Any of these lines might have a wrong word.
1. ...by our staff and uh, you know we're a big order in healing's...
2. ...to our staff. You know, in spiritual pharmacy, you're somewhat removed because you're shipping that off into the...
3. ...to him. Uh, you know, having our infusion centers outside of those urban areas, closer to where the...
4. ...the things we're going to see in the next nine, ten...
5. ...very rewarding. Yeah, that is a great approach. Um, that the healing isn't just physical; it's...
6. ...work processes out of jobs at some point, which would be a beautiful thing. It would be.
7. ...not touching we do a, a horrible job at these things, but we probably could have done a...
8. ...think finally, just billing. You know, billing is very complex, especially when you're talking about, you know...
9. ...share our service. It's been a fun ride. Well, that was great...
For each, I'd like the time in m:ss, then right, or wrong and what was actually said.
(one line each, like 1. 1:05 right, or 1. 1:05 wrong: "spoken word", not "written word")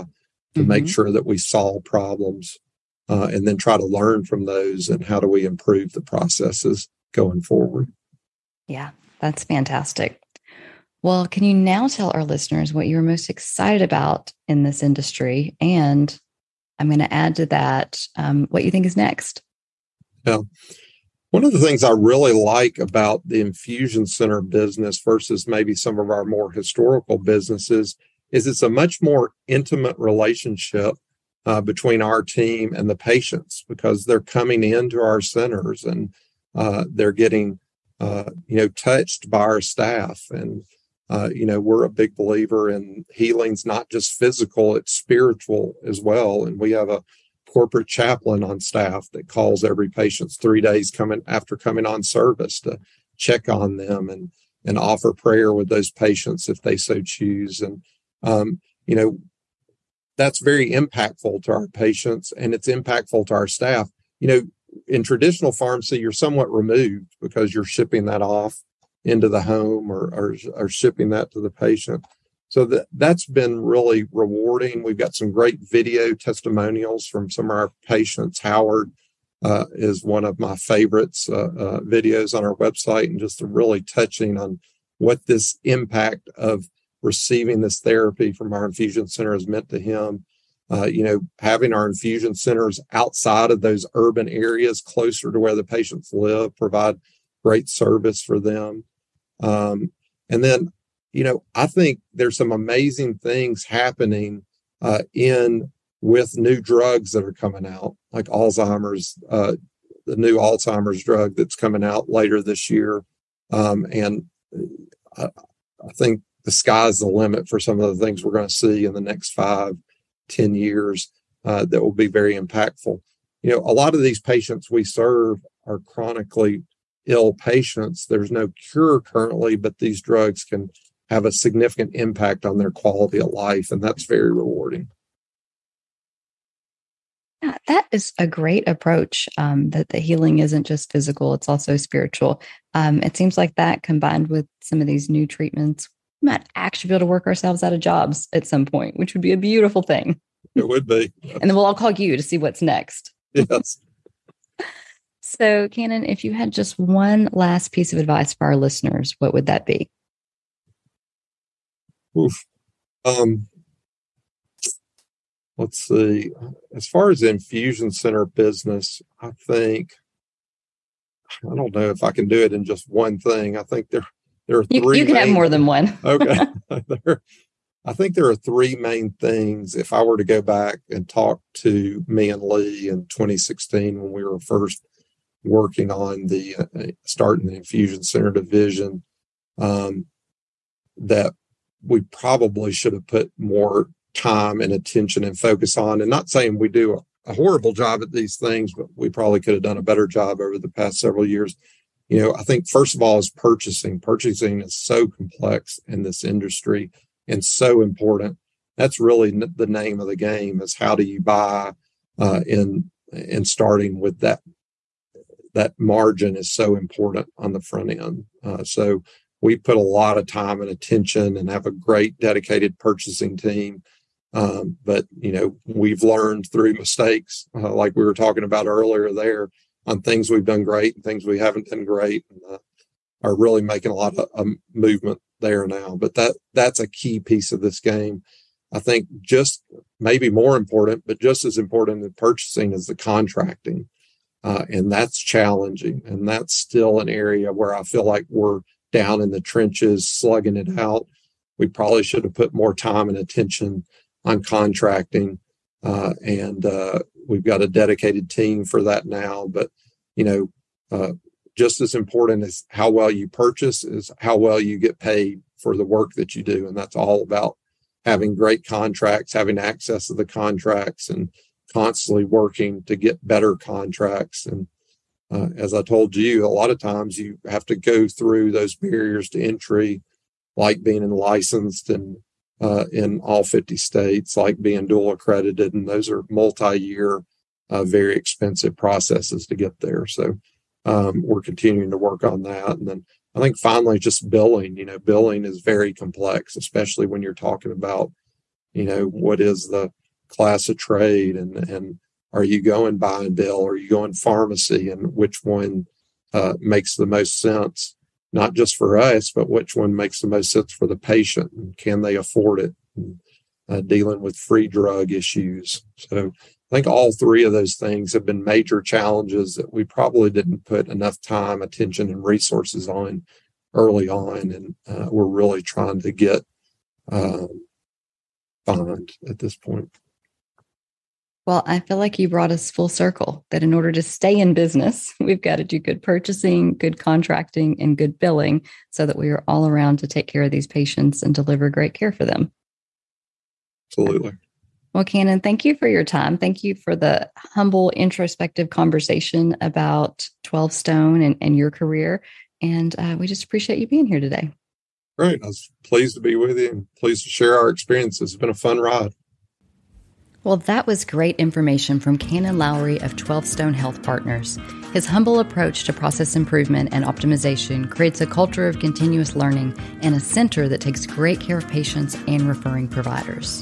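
1. 0:39 wrong: "believer", not "order"
2. 1:03 wrong: "traditional", not "spiritual"
3. 1:29 right
4. 1:57 wrong: "five", not "nine"
5. 2:14 right
6. 2:27 wrong: "ourselves", not "processes"
7. 3:16 wrong: "saying", not "touching"
8. 4:53 right
9. 5:57 wrong: "experience", not "service".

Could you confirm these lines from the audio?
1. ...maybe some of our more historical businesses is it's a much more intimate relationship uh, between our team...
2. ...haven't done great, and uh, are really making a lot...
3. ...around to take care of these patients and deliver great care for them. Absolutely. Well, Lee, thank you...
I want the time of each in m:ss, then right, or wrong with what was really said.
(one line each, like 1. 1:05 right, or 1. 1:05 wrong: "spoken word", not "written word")
1. 0:25 right
2. 3:51 right
3. 5:39 wrong: "Cannon", not "Lee".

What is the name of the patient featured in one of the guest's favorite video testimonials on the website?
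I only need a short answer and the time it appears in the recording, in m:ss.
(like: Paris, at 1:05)
Howard, at 1:18.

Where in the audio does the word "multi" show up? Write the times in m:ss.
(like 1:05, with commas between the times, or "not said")
4:46.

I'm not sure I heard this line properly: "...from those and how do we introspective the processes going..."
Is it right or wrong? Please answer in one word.
wrong.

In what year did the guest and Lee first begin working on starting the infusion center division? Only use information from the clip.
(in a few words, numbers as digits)
2016.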